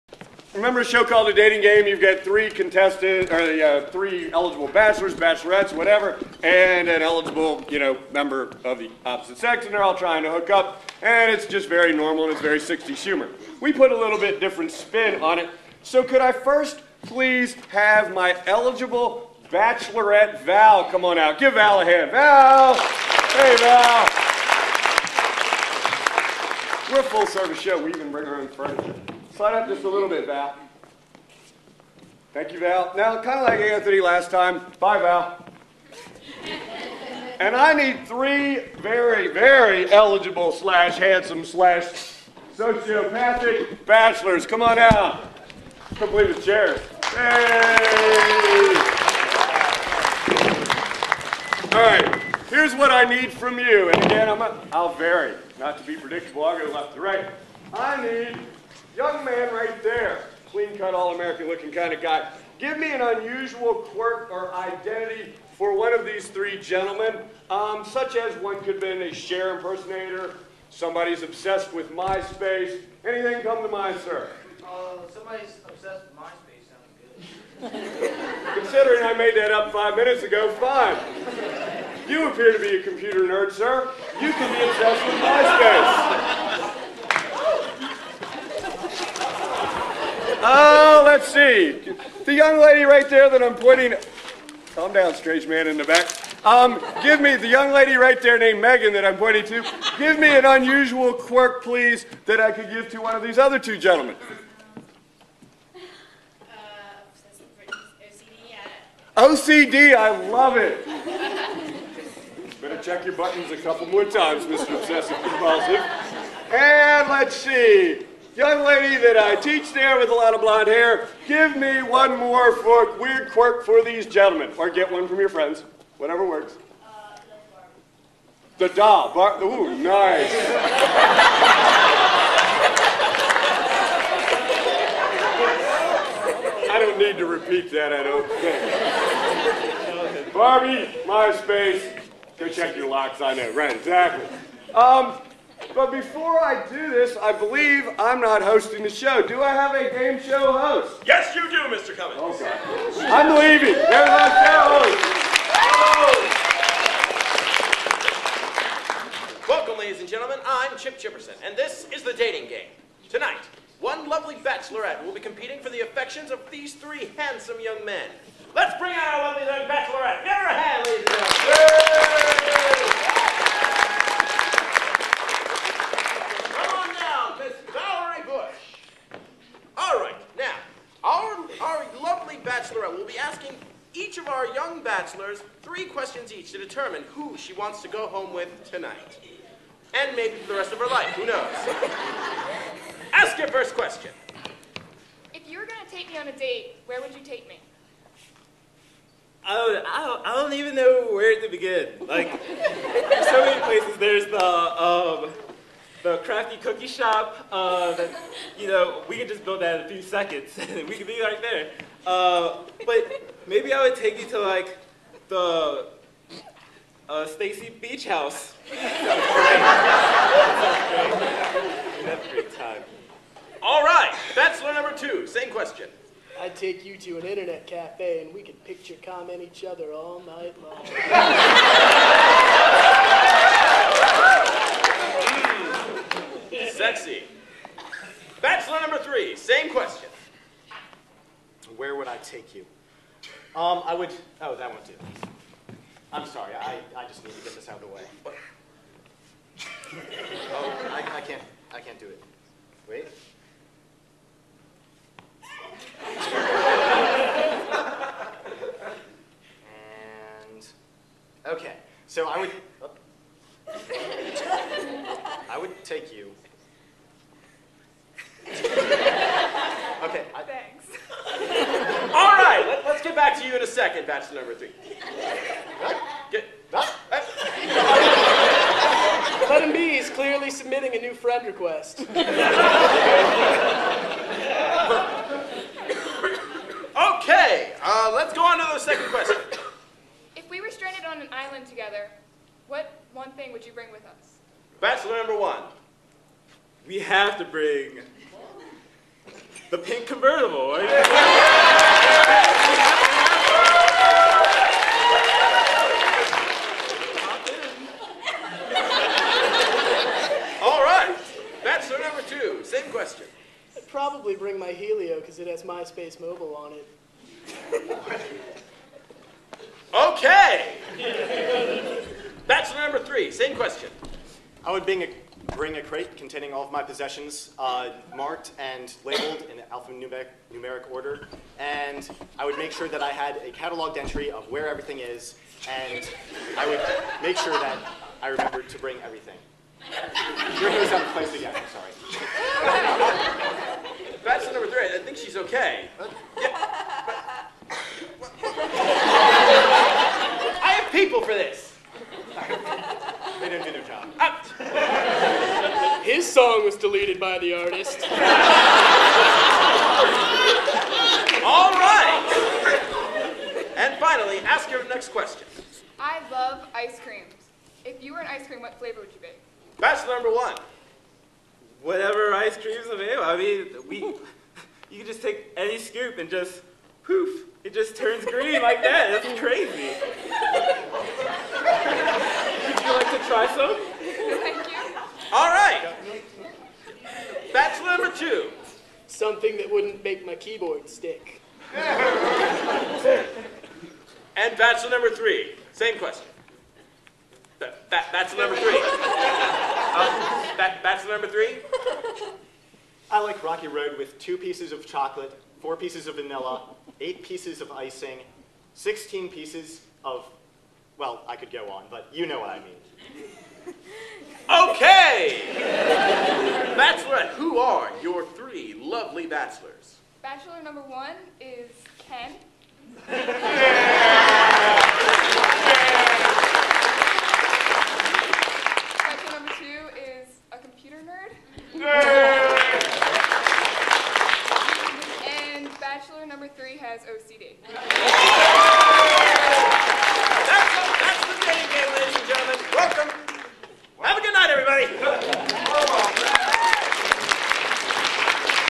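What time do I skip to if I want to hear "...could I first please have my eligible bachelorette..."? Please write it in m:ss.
0:16.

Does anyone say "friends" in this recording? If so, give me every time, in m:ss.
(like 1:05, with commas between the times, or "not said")
2:05, 4:41.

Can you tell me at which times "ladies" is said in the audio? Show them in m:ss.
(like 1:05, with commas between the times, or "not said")
2:39, 7:21.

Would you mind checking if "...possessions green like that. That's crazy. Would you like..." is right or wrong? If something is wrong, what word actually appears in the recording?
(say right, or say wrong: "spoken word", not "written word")
wrong: "turns", not "possessions".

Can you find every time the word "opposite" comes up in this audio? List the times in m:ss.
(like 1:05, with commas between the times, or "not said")
0:09.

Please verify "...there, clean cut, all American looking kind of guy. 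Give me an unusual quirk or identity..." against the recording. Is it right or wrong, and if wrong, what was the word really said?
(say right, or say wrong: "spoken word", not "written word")
right.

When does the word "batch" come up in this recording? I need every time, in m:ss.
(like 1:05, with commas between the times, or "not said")
4:34, 6:09, 6:27.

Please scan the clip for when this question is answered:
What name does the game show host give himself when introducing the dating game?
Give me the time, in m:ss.
2:40.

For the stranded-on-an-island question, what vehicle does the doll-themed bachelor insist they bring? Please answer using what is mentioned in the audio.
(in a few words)
Pink convertible.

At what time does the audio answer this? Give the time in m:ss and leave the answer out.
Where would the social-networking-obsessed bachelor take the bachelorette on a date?
3:47.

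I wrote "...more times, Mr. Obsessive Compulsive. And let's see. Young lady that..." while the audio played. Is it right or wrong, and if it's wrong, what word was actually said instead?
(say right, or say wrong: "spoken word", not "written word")
right.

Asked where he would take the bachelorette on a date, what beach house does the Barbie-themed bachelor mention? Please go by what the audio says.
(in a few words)
Stacy Beach House.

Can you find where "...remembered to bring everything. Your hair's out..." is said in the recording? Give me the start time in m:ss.
5:38.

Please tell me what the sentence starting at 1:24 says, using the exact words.
You can be obsessed with MySpace.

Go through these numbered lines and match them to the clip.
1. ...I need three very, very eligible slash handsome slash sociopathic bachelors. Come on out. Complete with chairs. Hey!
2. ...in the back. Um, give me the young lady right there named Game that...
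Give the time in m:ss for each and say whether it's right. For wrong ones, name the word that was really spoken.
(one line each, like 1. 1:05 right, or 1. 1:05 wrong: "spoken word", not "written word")
1. 0:37 right
2. 1:35 wrong: "Megan", not "Game".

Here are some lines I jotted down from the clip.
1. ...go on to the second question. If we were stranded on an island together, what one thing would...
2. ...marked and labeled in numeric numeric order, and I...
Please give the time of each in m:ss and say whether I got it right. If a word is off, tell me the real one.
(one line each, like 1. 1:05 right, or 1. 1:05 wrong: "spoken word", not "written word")
1. 4:48 right
2. 5:28 wrong: "alphanumeric", not "numeric".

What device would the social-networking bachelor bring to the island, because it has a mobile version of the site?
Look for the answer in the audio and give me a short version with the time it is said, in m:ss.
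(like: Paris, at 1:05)
Helio, at 5:14.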